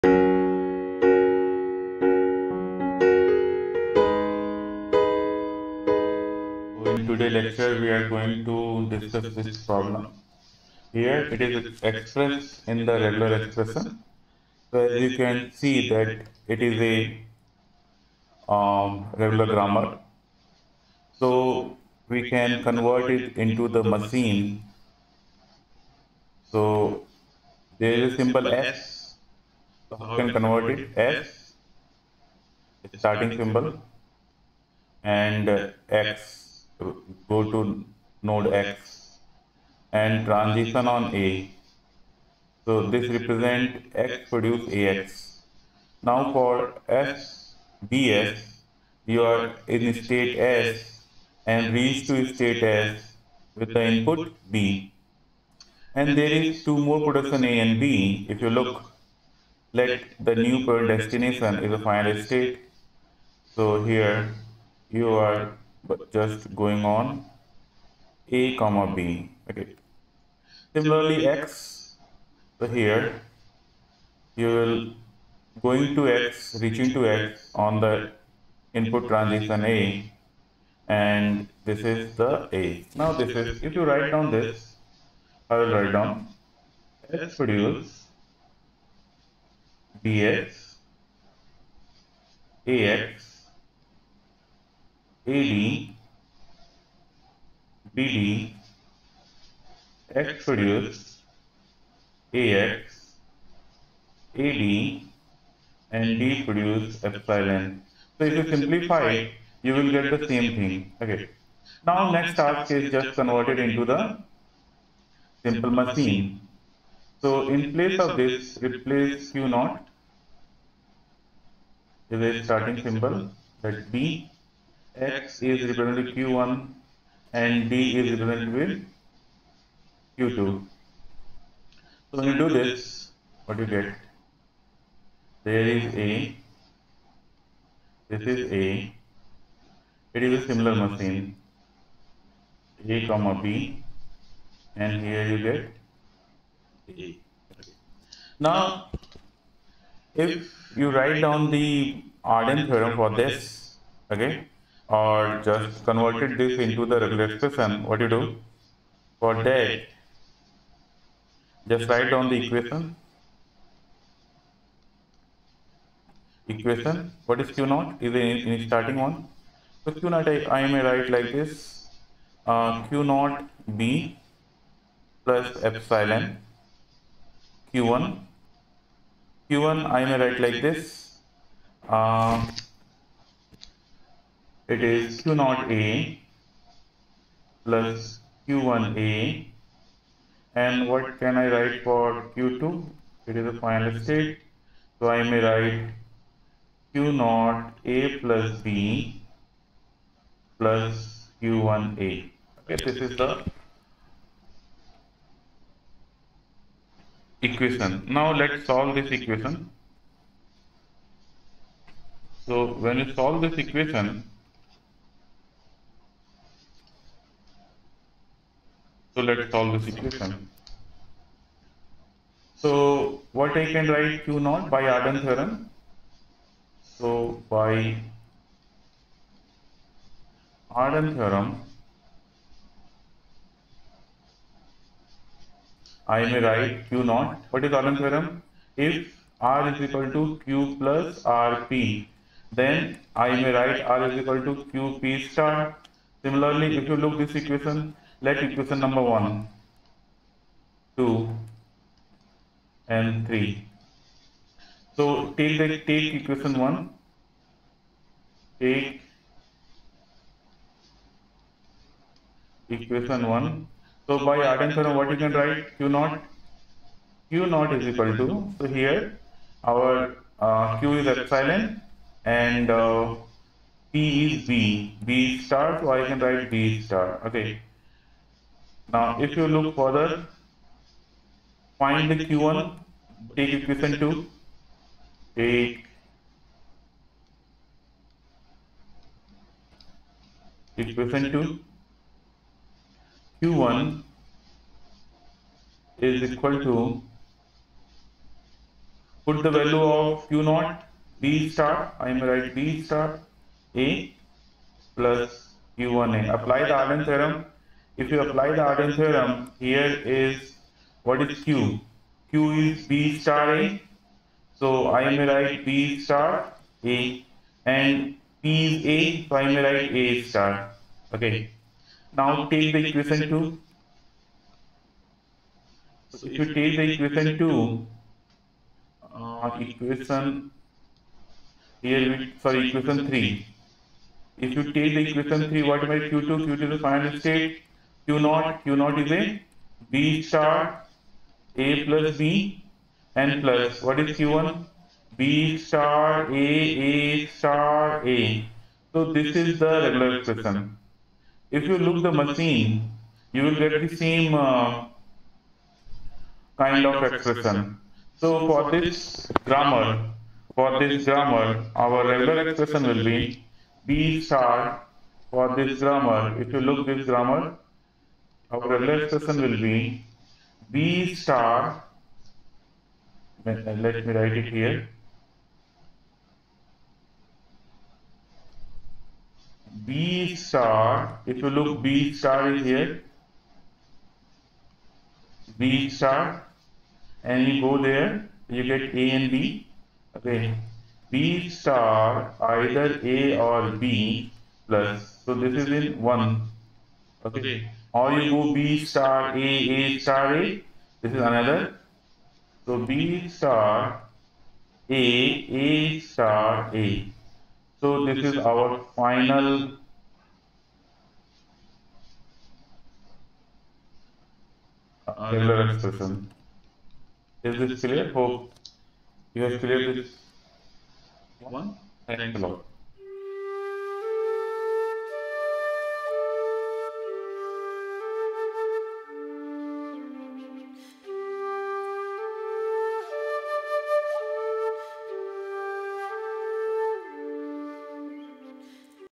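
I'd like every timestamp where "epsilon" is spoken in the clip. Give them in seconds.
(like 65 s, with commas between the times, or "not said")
107 s, 175 s, 271 s.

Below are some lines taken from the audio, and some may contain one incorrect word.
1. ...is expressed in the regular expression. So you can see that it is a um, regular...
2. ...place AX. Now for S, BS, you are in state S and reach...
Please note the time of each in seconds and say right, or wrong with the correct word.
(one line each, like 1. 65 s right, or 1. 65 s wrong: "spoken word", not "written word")
1. 11 s right
2. 44 s wrong: "produce", not "place".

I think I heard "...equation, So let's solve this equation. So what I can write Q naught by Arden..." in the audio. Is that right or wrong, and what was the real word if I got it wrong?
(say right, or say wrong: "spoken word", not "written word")
right.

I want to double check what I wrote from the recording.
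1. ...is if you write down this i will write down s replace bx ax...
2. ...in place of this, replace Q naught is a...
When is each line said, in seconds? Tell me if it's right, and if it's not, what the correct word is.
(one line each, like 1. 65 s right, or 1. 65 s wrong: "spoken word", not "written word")
1. 83 s wrong: "produce", not "replace"
2. 117 s right.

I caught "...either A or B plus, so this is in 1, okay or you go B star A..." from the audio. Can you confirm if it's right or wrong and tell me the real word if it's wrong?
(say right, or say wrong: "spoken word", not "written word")
right.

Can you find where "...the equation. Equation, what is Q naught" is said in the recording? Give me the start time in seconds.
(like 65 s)
162 s.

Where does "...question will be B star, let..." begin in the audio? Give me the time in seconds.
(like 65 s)
369 s.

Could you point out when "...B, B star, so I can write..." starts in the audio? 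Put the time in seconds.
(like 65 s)
274 s.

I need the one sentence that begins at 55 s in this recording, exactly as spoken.
And there is two more production A and B.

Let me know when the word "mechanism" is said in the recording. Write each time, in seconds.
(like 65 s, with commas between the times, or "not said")
not said.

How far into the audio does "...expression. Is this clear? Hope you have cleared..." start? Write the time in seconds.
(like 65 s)
415 s.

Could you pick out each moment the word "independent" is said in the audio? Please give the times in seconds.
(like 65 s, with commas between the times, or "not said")
not said.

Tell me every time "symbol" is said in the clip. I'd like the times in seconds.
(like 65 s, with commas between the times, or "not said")
33 s, 122 s.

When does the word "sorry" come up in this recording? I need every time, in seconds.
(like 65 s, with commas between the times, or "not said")
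332 s.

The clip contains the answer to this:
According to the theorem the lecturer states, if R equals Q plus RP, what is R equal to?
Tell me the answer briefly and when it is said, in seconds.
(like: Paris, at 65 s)
QP star, at 244 s.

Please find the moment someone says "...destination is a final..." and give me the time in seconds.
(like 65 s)
60 s.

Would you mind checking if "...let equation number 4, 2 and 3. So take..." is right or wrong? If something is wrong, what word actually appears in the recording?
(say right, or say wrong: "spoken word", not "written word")
wrong: "1", not "4".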